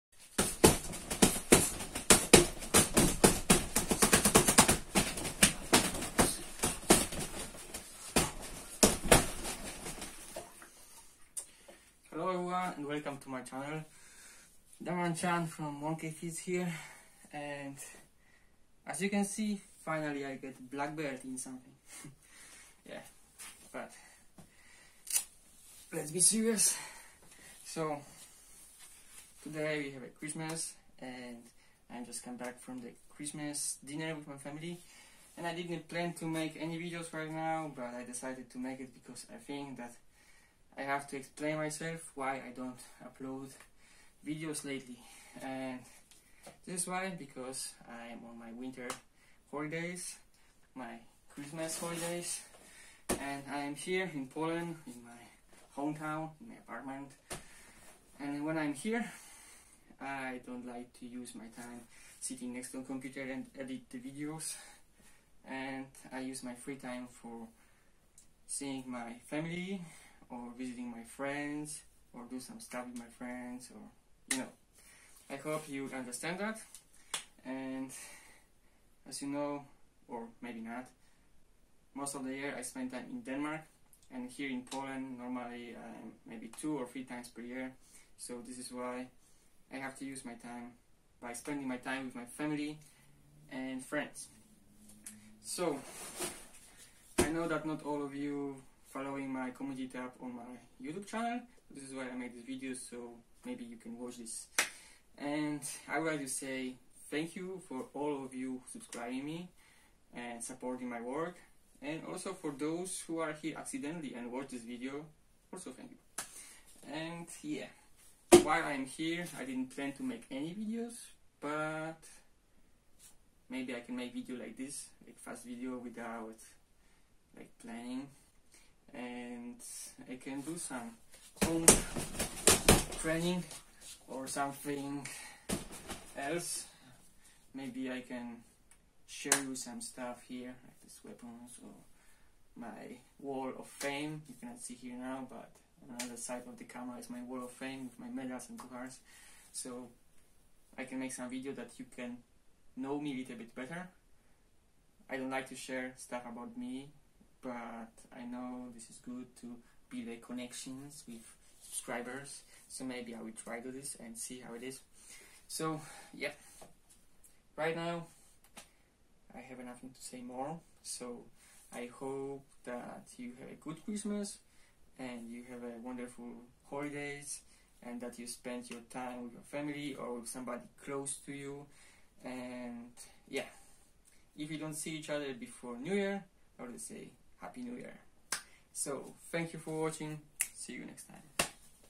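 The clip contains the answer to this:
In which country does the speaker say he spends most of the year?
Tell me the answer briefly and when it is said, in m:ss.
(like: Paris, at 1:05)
Denmark, at 1:23.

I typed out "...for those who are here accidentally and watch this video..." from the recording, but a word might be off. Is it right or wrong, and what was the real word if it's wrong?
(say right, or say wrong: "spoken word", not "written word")
right.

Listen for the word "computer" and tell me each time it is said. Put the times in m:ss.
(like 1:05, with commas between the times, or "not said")
1:02.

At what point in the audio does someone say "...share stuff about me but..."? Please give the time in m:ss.
2:35.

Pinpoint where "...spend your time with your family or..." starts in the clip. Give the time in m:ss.
2:58.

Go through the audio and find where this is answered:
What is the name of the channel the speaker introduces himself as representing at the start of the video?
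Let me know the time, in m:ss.
0:15.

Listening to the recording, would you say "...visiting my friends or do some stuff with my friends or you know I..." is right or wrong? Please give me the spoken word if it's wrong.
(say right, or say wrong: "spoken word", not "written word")
right.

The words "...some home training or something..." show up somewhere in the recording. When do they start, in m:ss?
2:10.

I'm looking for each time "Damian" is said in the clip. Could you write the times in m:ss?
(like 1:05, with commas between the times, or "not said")
0:14.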